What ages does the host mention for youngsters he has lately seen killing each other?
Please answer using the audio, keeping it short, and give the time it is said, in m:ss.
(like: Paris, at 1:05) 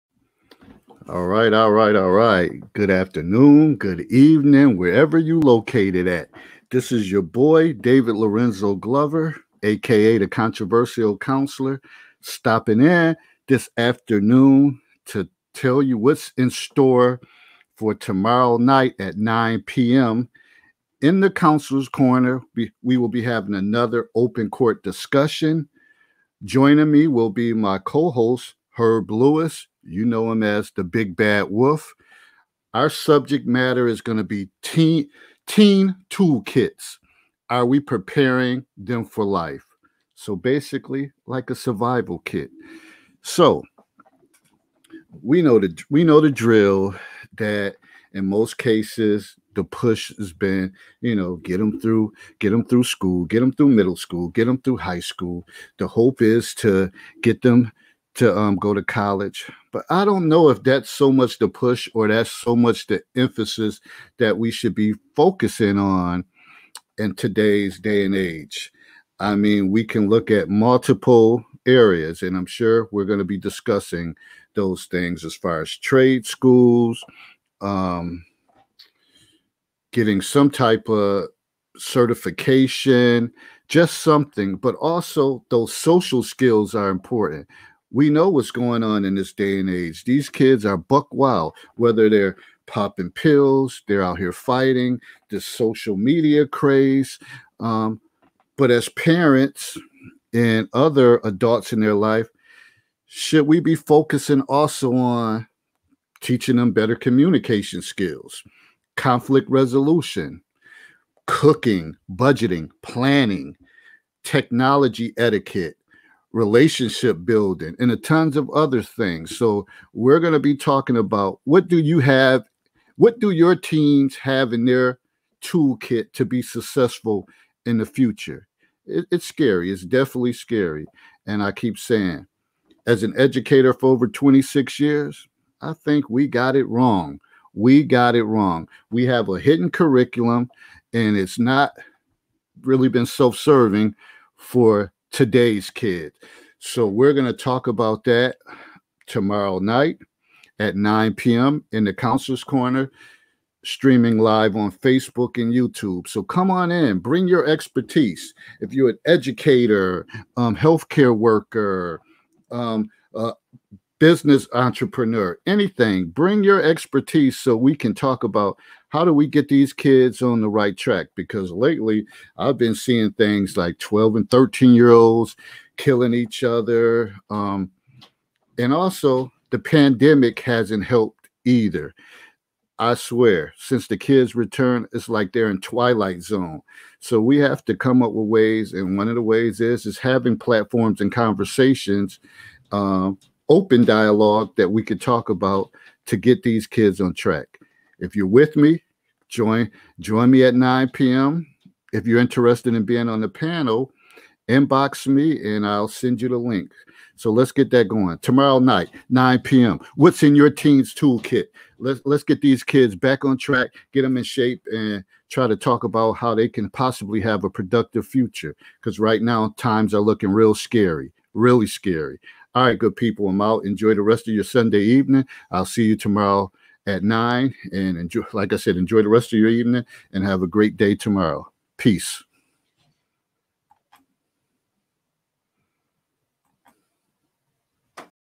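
12 and 13, at 2:53.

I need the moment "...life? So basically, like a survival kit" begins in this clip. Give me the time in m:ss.
0:39.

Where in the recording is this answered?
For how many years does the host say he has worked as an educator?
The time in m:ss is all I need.
2:14.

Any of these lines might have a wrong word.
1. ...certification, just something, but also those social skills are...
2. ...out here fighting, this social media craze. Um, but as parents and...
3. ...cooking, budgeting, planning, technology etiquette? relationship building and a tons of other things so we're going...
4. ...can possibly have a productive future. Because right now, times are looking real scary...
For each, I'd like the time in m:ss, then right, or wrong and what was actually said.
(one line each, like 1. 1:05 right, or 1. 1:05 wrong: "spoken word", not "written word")
1. 1:21 right
2. 1:34 right
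3. 1:51 right
4. 3:36 right.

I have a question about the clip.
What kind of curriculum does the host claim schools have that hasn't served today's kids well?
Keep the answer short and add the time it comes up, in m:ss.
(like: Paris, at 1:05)
hidden curriculum, at 2:19.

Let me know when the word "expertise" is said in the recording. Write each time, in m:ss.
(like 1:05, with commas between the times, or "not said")
2:37, 2:46.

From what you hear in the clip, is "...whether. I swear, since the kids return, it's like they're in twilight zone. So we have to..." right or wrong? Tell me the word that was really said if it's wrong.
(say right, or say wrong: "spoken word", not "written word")
wrong: "either", not "whether".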